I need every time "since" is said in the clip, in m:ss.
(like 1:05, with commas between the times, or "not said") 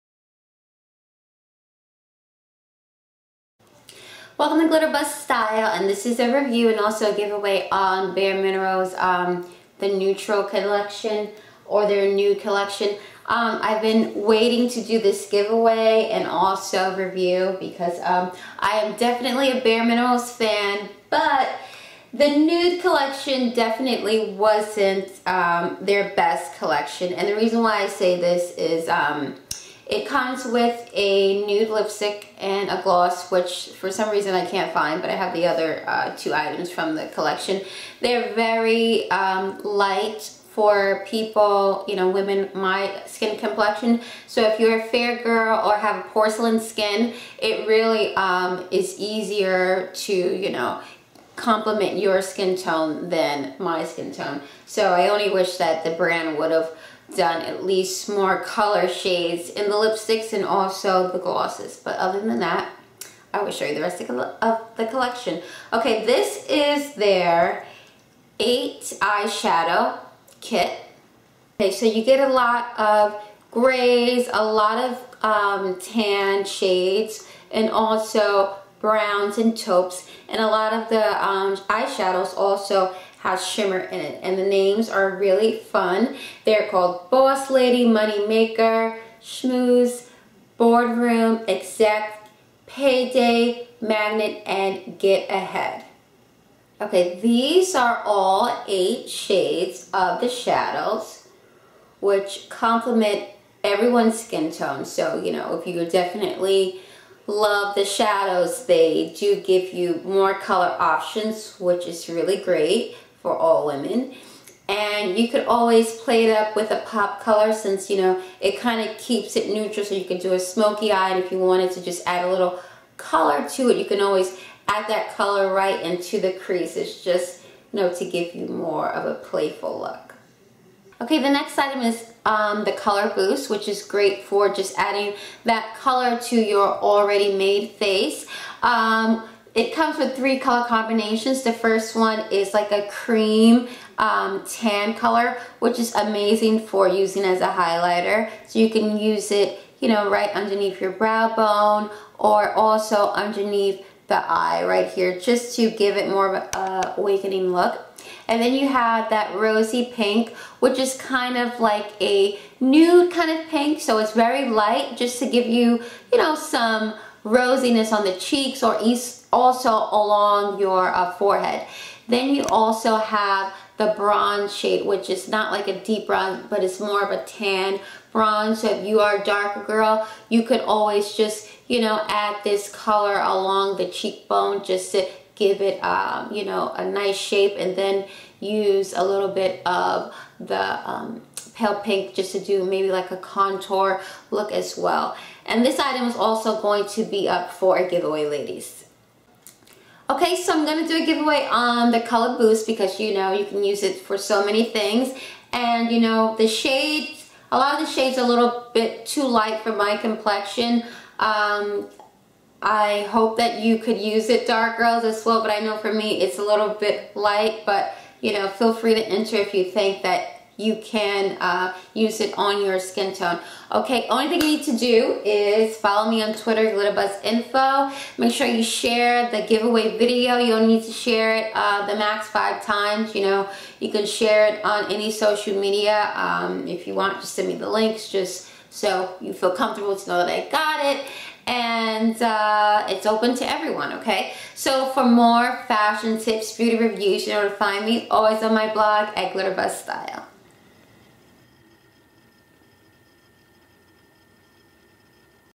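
1:57.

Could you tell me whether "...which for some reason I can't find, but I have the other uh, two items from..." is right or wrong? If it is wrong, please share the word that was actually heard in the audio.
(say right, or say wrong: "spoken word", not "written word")
right.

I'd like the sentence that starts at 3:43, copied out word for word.
Okay, only thing you need to do is follow me on Twitter, GlitterBuzz Info.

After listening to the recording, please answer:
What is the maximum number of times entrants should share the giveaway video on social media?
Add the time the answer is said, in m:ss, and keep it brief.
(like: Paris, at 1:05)
5, at 3:52.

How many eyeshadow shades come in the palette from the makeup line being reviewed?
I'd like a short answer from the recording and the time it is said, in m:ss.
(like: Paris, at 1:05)
8, at 1:08.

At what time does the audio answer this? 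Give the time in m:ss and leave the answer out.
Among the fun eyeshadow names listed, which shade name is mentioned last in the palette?
1:34.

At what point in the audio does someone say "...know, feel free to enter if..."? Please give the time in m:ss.
3:38.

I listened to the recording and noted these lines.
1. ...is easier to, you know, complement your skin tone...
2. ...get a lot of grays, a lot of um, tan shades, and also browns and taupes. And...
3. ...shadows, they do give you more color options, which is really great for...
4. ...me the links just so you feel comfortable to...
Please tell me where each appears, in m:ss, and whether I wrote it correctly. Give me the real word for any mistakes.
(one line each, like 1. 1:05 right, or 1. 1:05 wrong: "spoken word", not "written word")
1. 0:48 right
2. 1:12 right
3. 1:47 right
4. 3:57 right.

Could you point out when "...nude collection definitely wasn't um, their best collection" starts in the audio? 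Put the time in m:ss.
0:22.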